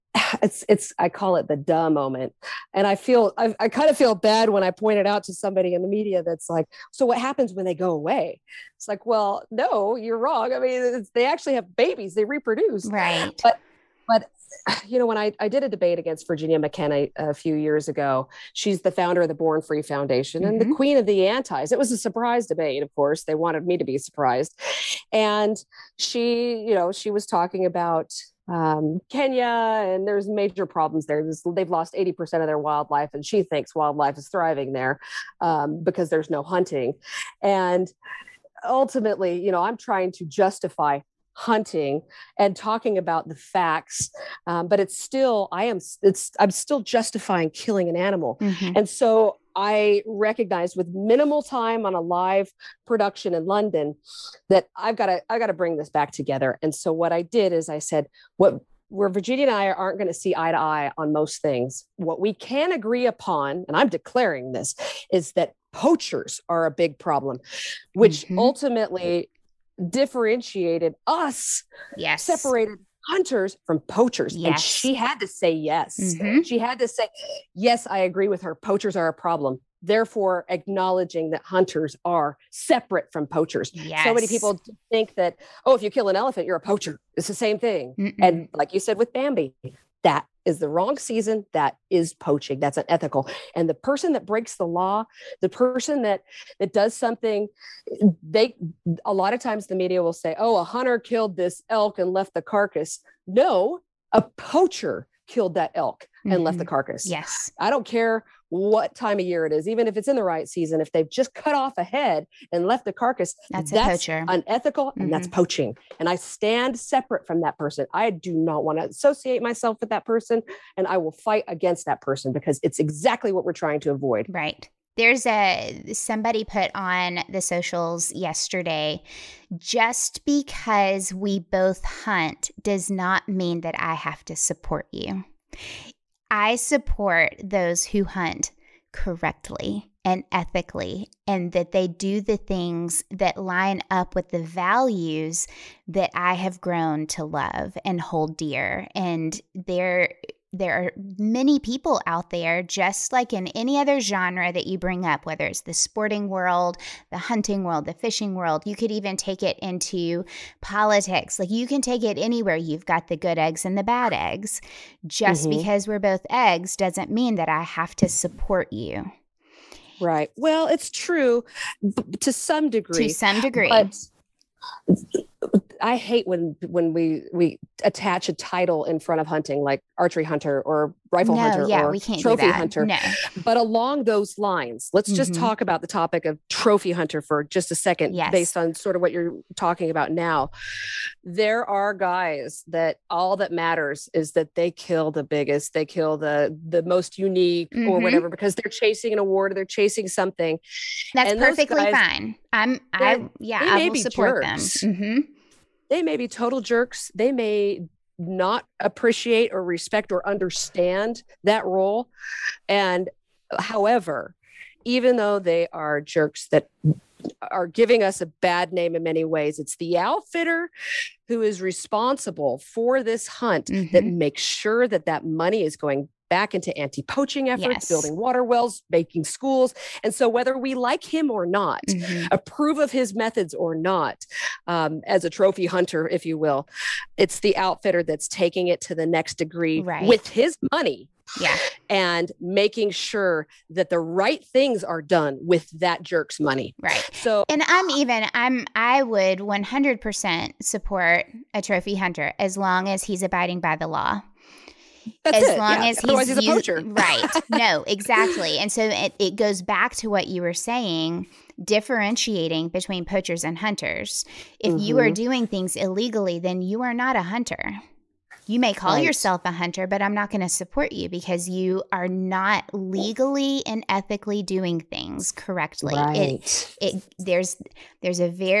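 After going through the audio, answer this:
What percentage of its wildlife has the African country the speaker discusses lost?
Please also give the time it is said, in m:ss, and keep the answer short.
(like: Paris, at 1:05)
80%, at 0:31.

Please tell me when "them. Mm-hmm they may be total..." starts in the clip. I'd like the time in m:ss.
3:24.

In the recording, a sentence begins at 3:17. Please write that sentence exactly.
or whatever because they're chasing an award or they're chasing something.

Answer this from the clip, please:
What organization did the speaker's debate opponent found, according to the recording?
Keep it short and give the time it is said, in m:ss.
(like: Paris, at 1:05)
Born Free Foundation, at 0:19.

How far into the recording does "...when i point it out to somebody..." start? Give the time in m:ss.
0:04.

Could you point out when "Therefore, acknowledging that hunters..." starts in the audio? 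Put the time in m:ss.
1:19.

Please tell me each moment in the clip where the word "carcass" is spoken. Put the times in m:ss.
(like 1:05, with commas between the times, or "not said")
1:42, 1:46, 1:52.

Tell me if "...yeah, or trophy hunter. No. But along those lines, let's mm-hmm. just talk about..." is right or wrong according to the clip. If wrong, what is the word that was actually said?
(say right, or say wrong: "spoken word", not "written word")
right.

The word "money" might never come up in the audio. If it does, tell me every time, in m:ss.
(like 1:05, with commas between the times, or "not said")
3:45, 4:00, 4:06.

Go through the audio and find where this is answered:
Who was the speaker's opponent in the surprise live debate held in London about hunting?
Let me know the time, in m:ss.
0:16.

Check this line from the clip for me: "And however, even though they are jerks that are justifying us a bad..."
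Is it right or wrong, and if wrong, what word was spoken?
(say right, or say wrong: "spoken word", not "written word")
wrong: "giving", not "justifying".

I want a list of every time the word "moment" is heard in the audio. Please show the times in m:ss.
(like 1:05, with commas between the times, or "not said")
0:01.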